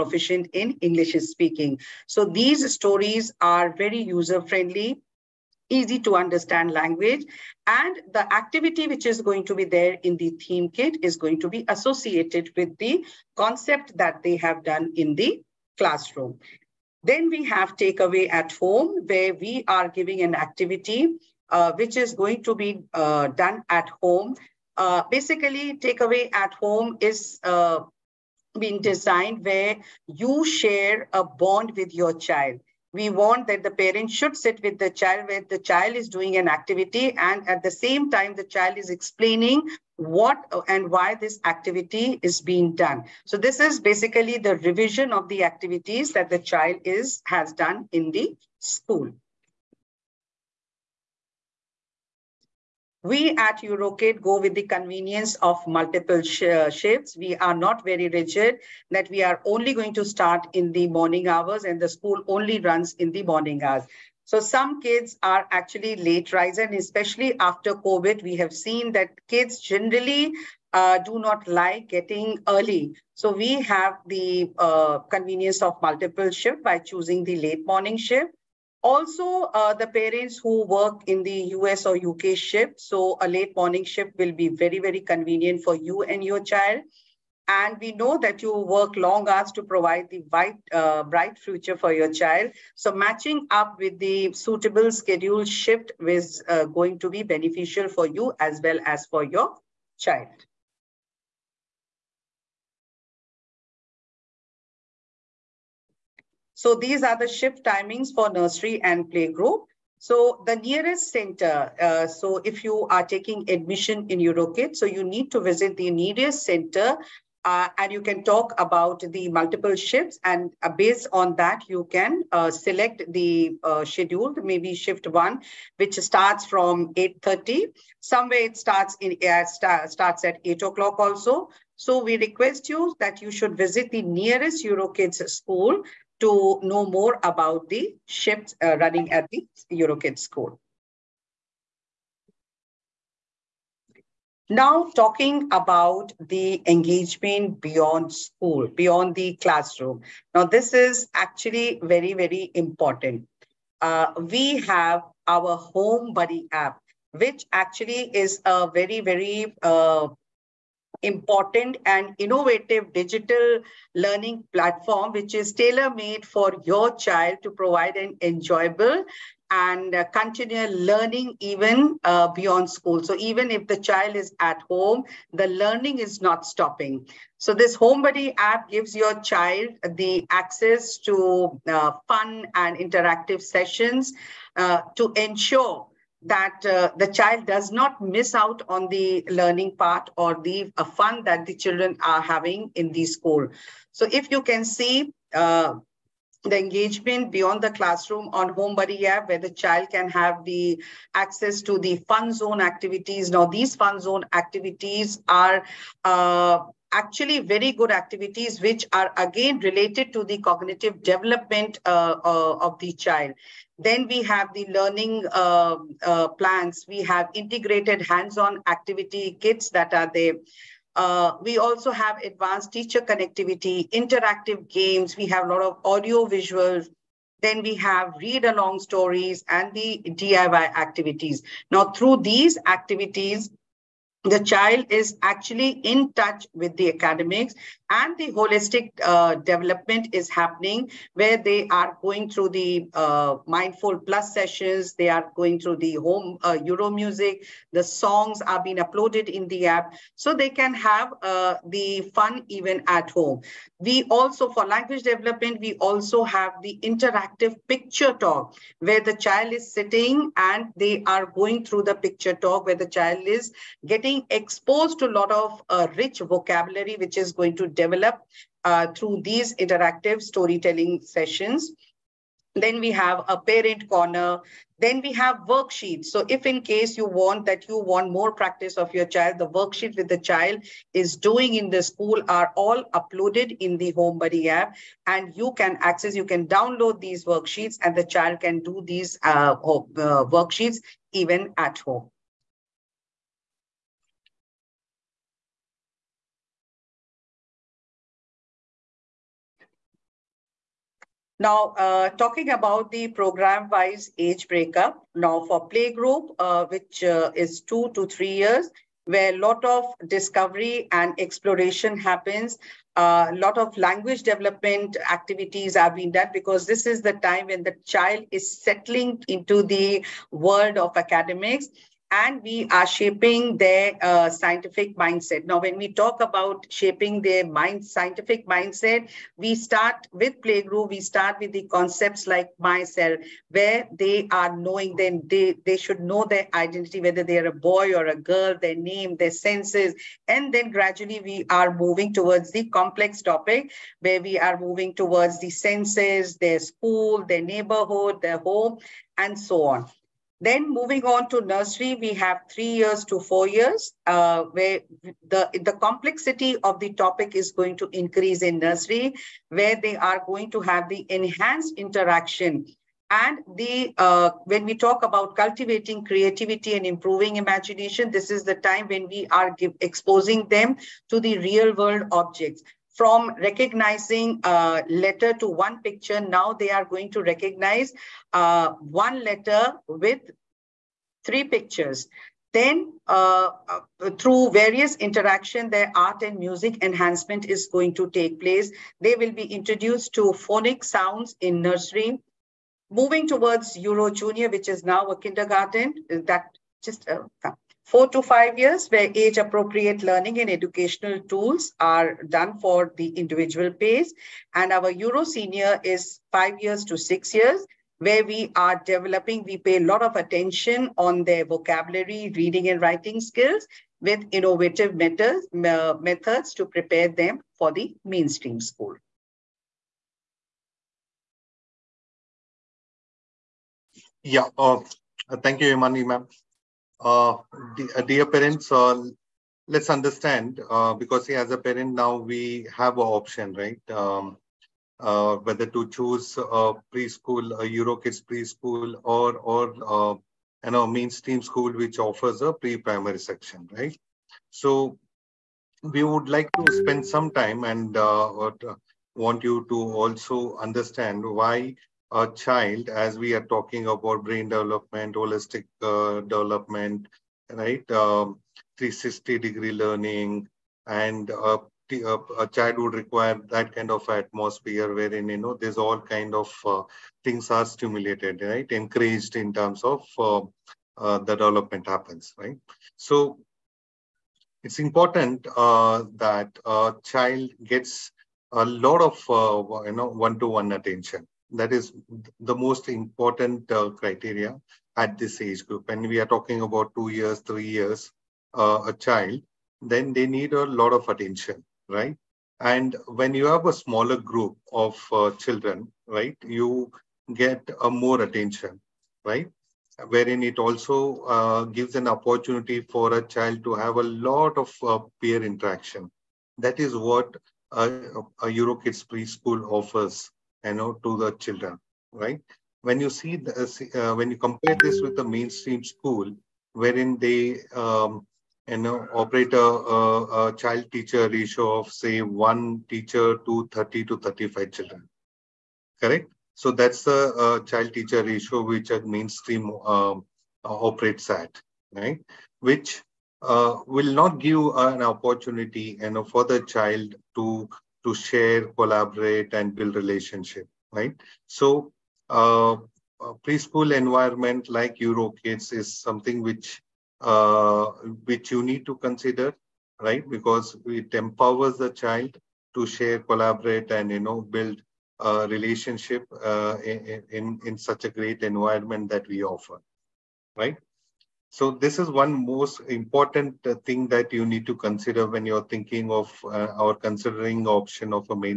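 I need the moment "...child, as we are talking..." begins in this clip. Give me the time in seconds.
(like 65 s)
452 s.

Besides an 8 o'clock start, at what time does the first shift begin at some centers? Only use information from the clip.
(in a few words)
8:30.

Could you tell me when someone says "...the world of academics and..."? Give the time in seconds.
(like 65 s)
319 s.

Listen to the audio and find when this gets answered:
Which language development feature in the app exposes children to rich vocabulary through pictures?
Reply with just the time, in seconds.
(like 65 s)
256 s.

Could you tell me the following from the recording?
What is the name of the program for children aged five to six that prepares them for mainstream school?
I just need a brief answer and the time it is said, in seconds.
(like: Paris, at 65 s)
Euro Senior, at 404 s.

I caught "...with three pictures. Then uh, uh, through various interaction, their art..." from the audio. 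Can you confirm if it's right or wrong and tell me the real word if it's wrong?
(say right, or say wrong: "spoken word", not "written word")
right.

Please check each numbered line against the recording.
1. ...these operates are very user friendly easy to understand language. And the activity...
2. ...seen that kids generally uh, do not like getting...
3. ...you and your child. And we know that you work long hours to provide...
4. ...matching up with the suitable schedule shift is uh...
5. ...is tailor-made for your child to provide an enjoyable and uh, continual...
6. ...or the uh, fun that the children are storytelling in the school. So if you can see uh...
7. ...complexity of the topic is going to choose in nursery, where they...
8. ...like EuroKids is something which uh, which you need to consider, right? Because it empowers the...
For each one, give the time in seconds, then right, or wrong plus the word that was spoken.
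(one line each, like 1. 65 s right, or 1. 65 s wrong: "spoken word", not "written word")
1. 2 s wrong: "stories", not "operates"
2. 68 s right
3. 85 s right
4. 92 s right
5. 165 s right
6. 190 s wrong: "having", not "storytelling"
7. 355 s wrong: "increase", not "choose"
8. 544 s right.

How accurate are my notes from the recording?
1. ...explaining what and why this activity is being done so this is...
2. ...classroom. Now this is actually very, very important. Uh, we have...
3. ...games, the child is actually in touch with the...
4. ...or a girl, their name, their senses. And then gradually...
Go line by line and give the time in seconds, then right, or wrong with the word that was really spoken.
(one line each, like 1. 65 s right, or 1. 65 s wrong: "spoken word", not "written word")
1. 38 s right
2. 149 s right
3. 232 s wrong: "activities", not "games"
4. 337 s right.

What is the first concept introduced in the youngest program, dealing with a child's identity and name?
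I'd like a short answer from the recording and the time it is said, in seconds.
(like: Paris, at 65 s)
Myself, at 332 s.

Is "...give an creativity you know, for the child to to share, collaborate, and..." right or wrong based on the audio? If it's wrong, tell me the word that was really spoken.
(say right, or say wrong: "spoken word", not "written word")
wrong: "opportunity", not "creativity".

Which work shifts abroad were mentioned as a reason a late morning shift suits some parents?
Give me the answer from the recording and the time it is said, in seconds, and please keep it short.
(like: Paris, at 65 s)
US or UK, at 81 s.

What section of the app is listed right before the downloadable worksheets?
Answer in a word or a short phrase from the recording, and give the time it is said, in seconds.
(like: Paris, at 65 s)
Parent corner, at 273 s.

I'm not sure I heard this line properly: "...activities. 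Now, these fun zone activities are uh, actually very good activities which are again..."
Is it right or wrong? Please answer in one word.
right.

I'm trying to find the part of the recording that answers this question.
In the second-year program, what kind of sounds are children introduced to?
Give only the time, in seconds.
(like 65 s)
390 s.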